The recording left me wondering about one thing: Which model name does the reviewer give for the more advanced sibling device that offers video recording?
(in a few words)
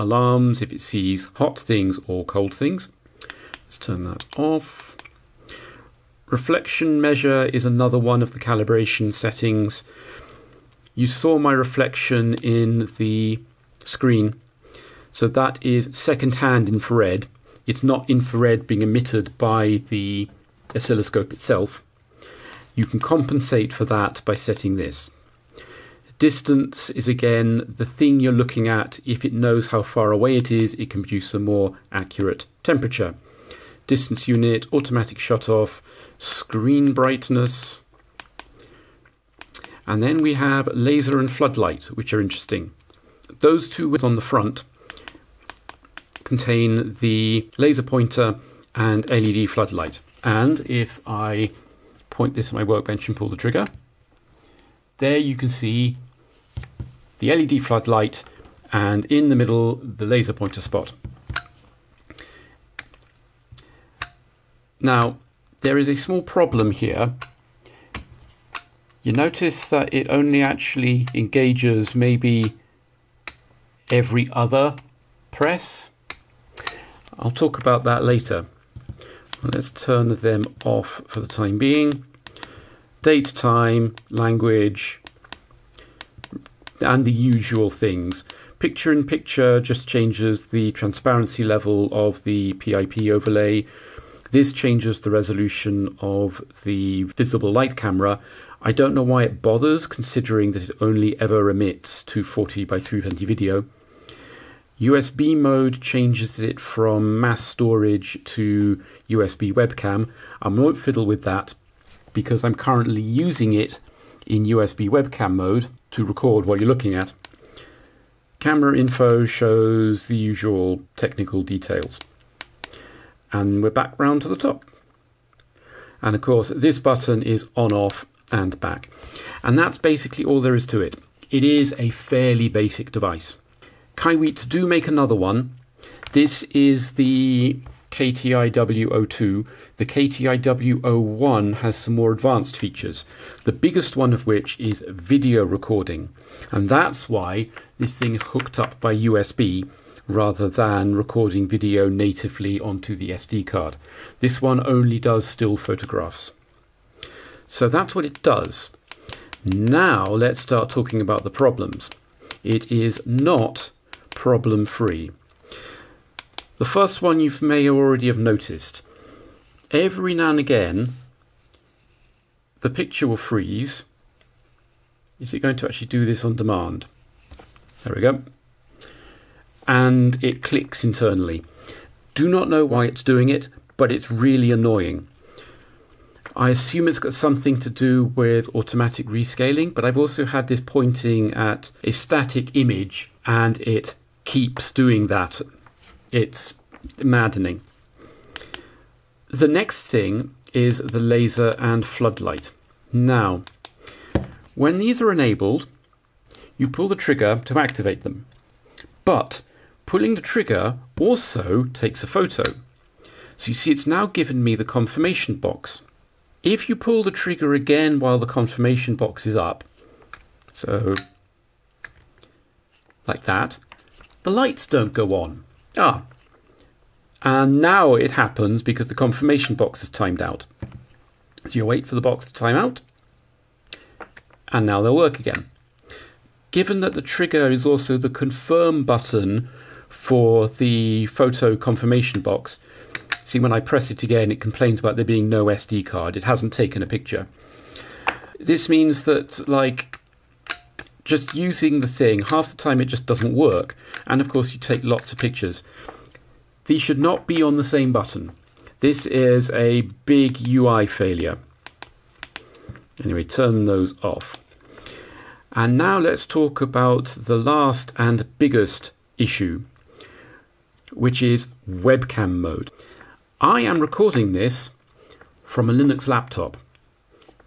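KTIW01.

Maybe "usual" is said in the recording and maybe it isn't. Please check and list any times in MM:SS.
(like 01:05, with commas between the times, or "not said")
01:27, 02:00.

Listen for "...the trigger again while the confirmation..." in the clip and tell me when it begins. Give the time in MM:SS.
03:37.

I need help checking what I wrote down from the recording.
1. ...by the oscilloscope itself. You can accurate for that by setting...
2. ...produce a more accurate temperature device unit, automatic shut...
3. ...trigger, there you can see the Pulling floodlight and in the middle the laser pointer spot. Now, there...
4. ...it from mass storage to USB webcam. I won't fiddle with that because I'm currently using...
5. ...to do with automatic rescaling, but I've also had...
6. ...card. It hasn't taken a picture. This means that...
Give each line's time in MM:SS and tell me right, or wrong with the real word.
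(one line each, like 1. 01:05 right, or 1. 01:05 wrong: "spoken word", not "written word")
1. 00:19 wrong: "compensate", not "accurate"
2. 00:31 wrong: "distance", not "device"
3. 00:53 wrong: "LED", not "Pulling"
4. 01:46 right
5. 03:07 right
6. 04:05 right.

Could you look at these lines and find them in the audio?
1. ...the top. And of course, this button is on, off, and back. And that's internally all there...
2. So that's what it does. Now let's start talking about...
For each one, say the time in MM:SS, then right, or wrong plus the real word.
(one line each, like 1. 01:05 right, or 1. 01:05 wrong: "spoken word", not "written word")
1. 02:04 wrong: "basically", not "internally"
2. 02:37 right.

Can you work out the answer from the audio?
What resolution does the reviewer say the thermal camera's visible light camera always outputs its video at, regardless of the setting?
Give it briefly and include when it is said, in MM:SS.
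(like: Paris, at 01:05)
240 by 320, at 01:42.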